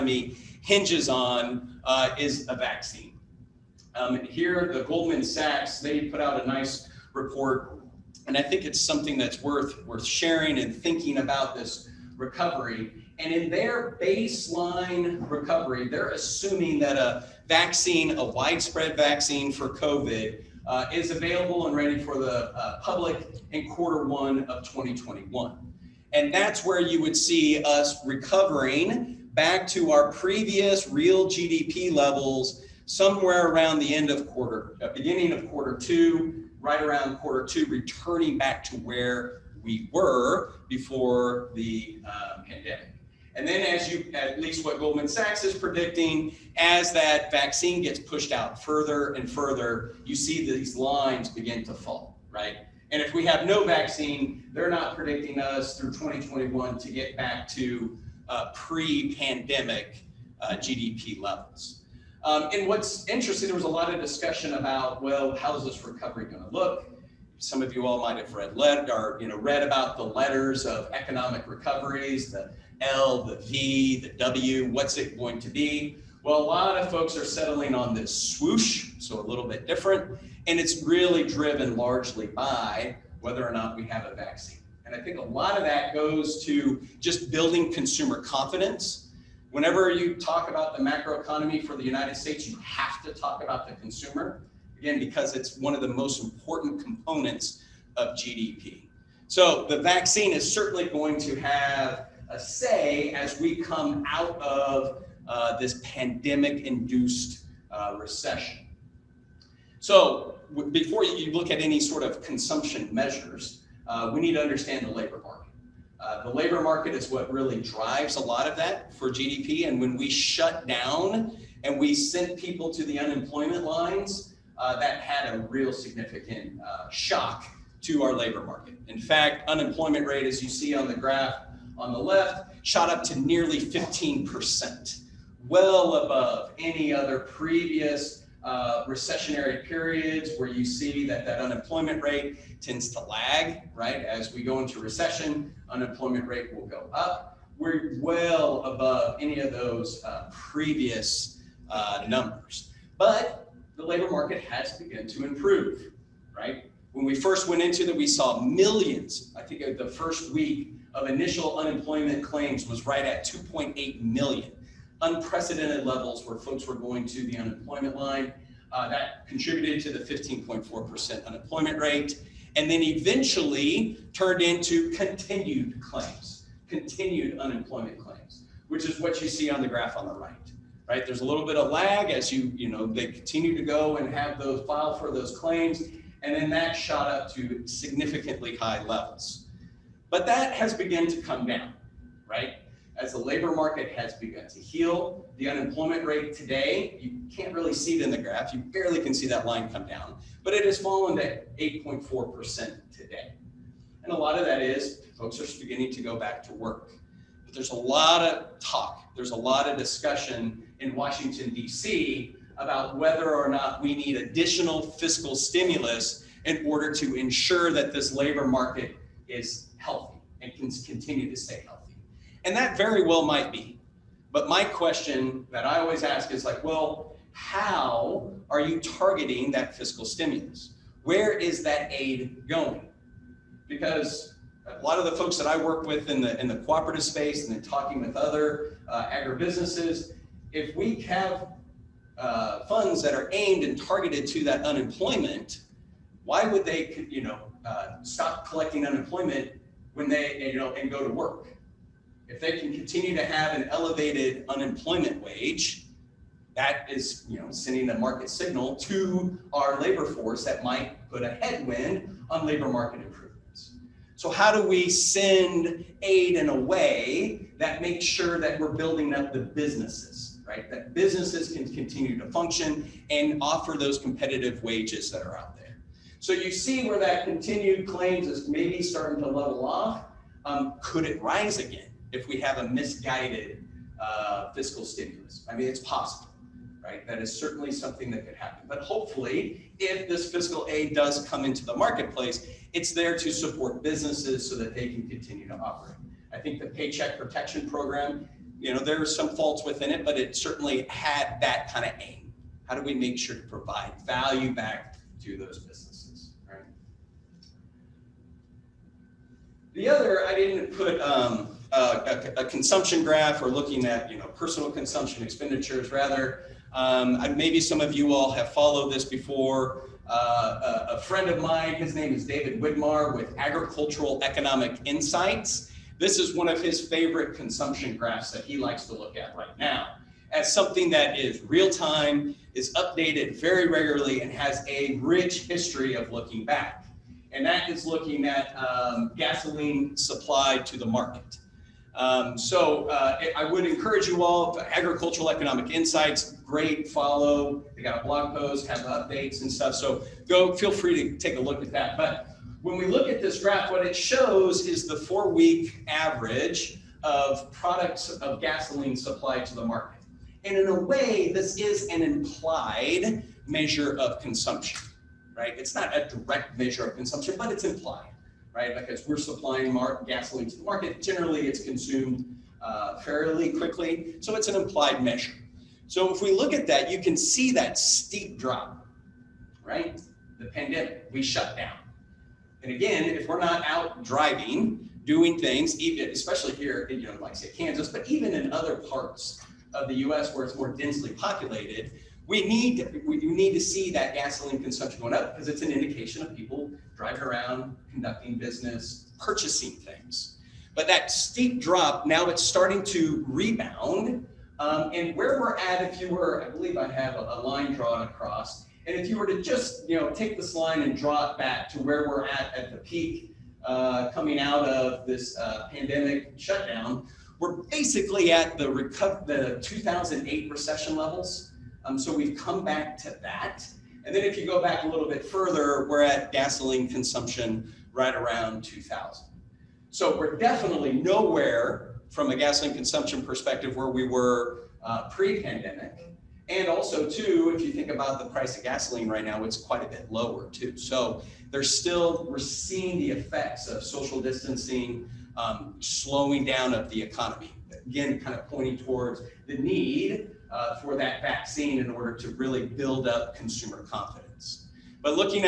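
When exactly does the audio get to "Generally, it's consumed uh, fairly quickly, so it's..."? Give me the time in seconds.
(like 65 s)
371 s.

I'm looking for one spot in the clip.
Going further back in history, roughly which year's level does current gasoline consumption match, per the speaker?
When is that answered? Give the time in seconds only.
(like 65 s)
428 s.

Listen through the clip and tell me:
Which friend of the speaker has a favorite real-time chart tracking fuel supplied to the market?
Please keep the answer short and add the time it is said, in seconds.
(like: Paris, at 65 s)
David Widmar, at 322 s.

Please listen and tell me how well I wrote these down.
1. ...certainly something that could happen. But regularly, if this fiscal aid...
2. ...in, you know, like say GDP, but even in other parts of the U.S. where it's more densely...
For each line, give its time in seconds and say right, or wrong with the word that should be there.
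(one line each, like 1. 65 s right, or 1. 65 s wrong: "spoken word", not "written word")
1. 287 s wrong: "hopefully", not "regularly"
2. 386 s wrong: "Kansas", not "GDP".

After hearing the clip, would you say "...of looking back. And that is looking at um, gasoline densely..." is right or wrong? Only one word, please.
wrong.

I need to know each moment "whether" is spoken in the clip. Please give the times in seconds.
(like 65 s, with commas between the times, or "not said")
83 s, 212 s.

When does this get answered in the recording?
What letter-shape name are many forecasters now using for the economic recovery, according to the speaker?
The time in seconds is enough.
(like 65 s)
78 s.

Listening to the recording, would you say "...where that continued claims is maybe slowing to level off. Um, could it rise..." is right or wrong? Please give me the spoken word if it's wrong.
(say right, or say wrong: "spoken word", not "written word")
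wrong: "starting", not "slowing".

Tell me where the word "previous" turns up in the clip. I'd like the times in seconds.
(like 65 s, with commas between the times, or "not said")
30 s, 137 s, 150 s.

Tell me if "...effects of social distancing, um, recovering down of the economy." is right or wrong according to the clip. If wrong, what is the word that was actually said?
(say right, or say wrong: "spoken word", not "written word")
wrong: "slowing", not "recovering".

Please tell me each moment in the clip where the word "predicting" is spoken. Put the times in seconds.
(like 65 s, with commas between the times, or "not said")
45 s, 54 s.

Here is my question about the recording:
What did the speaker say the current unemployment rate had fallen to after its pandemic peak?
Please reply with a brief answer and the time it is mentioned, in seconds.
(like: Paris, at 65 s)
8.4%, at 201 s.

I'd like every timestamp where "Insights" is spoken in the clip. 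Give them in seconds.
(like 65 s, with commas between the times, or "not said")
324 s, 345 s.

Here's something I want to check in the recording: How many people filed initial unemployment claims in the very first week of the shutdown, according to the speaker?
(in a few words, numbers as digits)
2.8 million.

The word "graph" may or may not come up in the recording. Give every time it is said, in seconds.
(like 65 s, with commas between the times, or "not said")
130 s, 179 s, 198 s, 313 s, 327 s, 353 s.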